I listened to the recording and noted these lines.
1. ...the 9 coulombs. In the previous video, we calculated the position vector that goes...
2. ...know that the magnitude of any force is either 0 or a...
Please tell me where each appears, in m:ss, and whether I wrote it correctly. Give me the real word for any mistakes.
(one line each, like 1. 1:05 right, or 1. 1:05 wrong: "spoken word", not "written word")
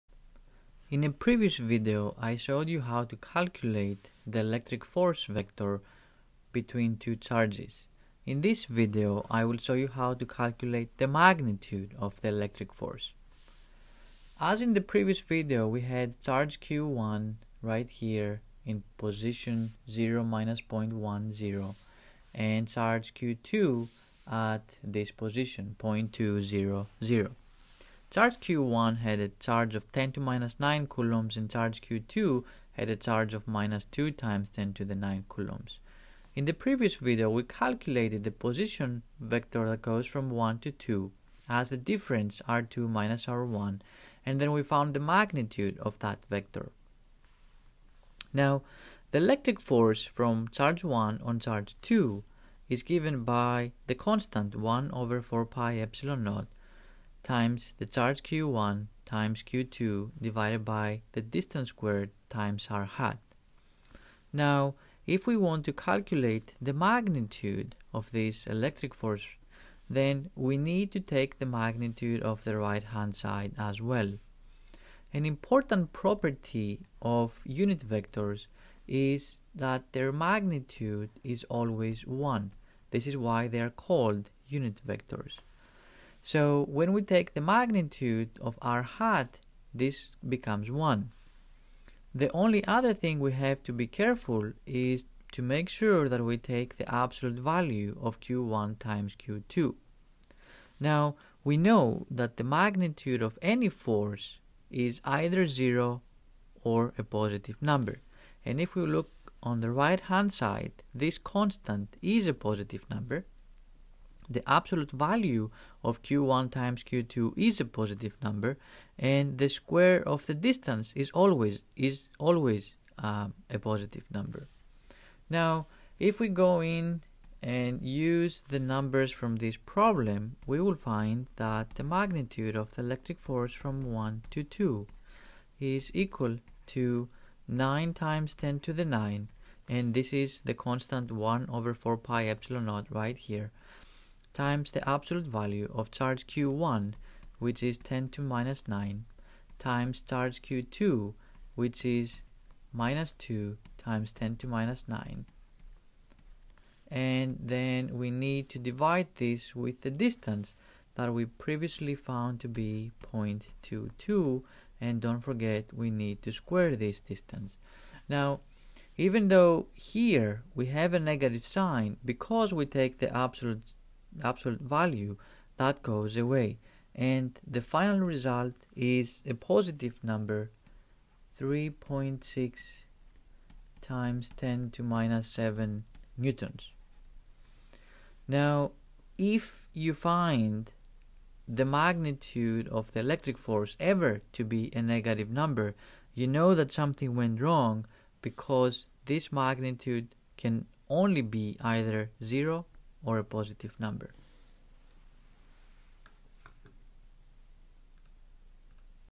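1. 0:34 right
2. 1:41 right.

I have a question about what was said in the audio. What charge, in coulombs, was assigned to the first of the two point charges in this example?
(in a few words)
10^-9 coulombs.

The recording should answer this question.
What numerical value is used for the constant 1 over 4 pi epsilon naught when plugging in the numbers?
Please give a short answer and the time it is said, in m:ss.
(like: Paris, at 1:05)
9 times 10^9, at 2:17.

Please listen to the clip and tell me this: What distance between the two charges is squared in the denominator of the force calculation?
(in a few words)
0.22.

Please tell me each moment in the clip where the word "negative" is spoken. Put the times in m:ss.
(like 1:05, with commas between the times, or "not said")
2:50, 3:14.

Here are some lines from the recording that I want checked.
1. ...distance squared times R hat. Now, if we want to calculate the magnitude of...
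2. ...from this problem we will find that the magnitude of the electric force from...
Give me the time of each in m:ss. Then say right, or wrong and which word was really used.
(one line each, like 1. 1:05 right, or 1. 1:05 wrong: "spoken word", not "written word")
1. 1:01 right
2. 2:09 right.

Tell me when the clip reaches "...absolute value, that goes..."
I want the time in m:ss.
2:54.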